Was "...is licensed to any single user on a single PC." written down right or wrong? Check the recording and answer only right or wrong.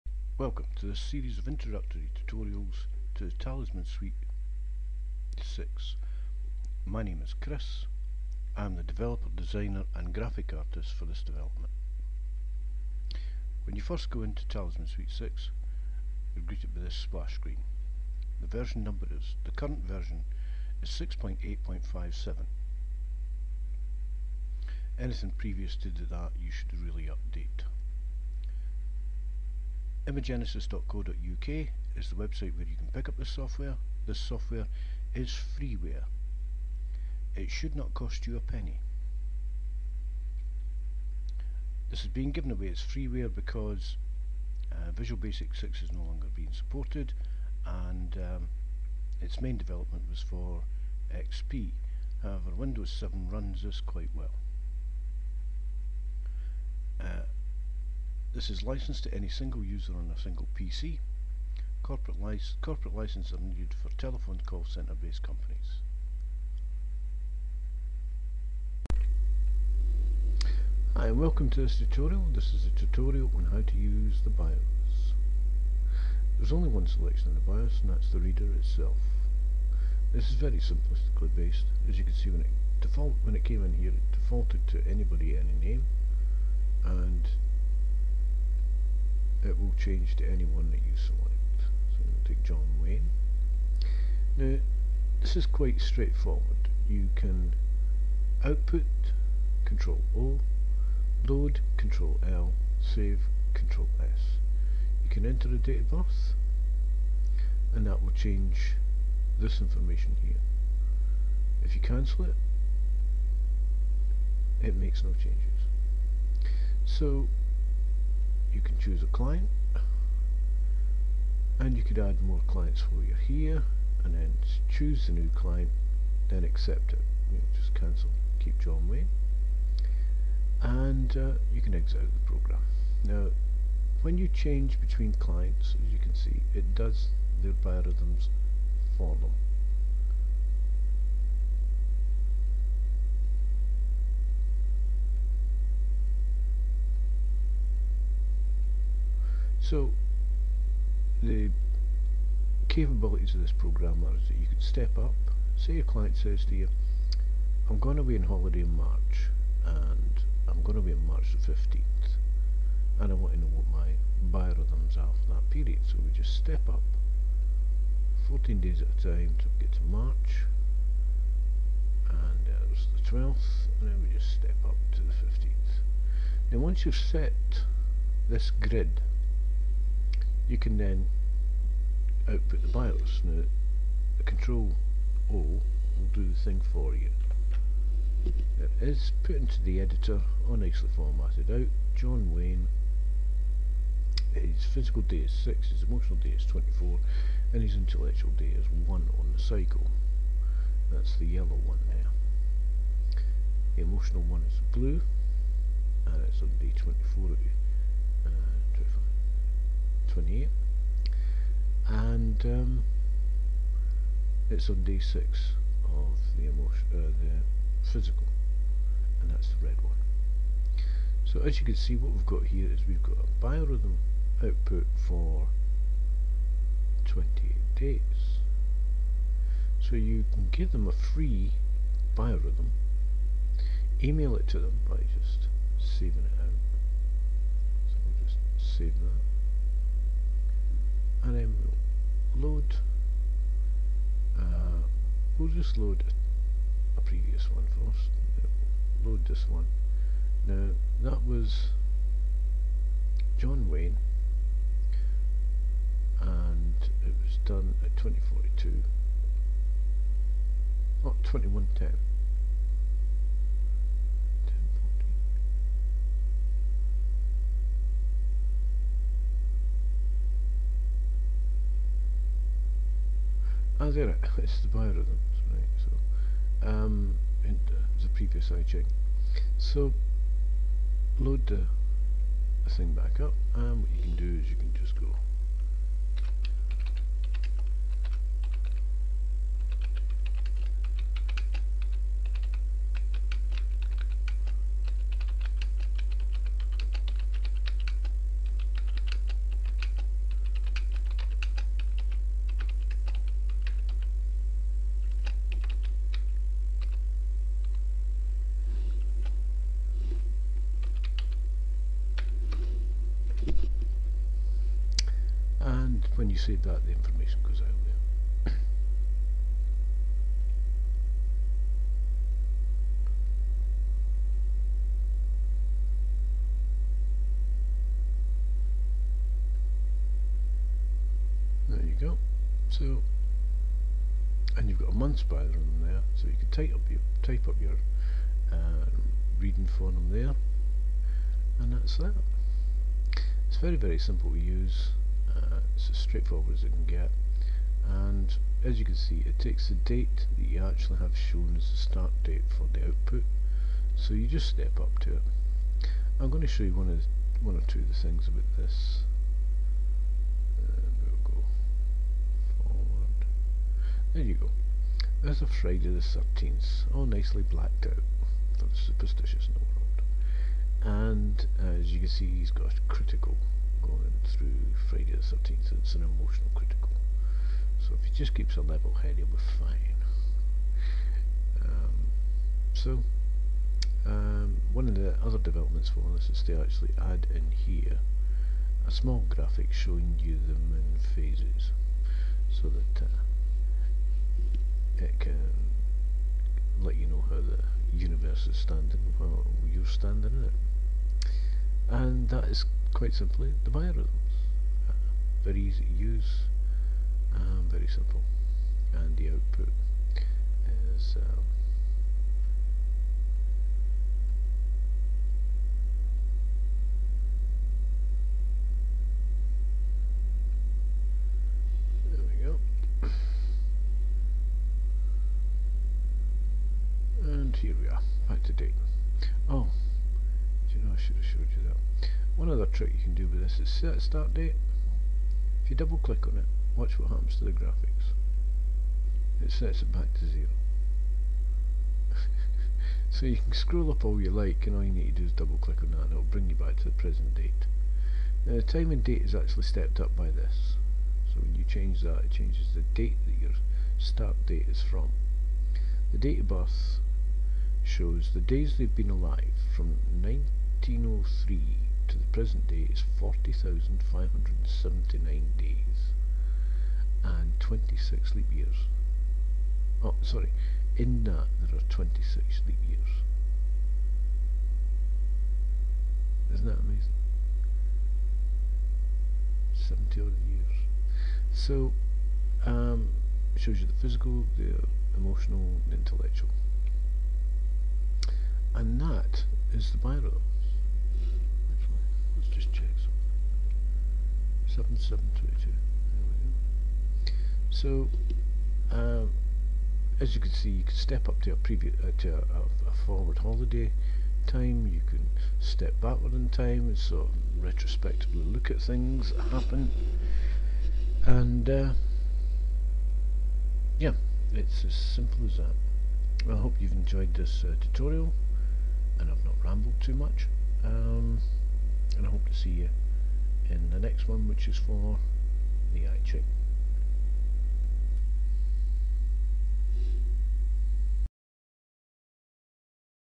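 right.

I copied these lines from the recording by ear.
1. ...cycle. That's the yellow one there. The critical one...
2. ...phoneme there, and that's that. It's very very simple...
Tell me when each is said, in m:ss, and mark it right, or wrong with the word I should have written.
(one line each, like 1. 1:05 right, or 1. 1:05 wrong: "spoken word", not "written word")
1. 3:19 wrong: "emotional", not "critical"
2. 5:39 right.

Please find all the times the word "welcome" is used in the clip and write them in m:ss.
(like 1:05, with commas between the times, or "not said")
0:00, 1:11.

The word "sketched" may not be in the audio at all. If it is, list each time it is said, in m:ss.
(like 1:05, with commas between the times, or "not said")
not said.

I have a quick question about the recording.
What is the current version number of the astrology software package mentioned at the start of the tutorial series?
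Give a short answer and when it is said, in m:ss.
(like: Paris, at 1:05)
6.8.57, at 0:20.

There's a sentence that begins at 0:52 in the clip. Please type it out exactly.
However, Windows 7 runs this quite well.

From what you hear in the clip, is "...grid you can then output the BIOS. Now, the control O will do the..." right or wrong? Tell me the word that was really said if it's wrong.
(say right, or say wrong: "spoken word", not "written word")
right.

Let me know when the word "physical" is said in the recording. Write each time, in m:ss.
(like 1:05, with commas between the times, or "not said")
3:14, 3:37, 8:03.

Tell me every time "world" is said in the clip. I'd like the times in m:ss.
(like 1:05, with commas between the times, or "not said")
6:10.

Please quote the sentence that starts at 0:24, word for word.
Anything previous to that you should really update imagenesis.co.uk is the website where you can pick up this software.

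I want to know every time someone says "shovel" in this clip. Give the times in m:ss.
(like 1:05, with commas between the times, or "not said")
not said.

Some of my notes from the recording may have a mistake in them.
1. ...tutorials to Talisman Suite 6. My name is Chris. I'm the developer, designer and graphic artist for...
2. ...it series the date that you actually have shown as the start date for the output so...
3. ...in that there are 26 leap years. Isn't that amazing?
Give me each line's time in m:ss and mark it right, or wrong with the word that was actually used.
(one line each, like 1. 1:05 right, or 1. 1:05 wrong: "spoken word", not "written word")
1. 0:02 right
2. 5:49 wrong: "takes", not "series"
3. 7:50 right.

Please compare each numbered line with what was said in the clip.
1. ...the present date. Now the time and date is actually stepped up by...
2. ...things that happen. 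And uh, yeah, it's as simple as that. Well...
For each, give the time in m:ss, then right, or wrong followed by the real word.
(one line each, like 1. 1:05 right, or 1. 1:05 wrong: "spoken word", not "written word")
1. 7:26 right
2. 8:28 right.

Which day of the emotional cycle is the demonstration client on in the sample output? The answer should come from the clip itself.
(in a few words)
24.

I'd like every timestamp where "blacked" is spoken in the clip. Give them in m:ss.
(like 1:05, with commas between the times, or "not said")
6:07.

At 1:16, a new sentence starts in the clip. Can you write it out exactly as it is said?
There's only one selection in the BIOS and that's the reader itself.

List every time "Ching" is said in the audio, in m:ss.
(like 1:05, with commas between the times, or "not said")
4:38, 8:46.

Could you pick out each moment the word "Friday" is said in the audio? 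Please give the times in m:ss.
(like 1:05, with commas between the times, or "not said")
6:05, 6:14.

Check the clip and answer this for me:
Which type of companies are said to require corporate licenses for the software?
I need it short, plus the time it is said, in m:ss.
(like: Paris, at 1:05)
telephone call center, at 1:03.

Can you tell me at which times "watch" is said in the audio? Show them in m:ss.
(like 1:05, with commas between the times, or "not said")
7:16.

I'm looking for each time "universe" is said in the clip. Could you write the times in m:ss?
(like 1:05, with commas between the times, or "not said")
6:37.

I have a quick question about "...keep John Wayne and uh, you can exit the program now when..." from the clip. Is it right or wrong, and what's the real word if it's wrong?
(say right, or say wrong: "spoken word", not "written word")
right.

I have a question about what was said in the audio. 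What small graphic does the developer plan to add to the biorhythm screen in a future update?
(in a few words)
moon phases.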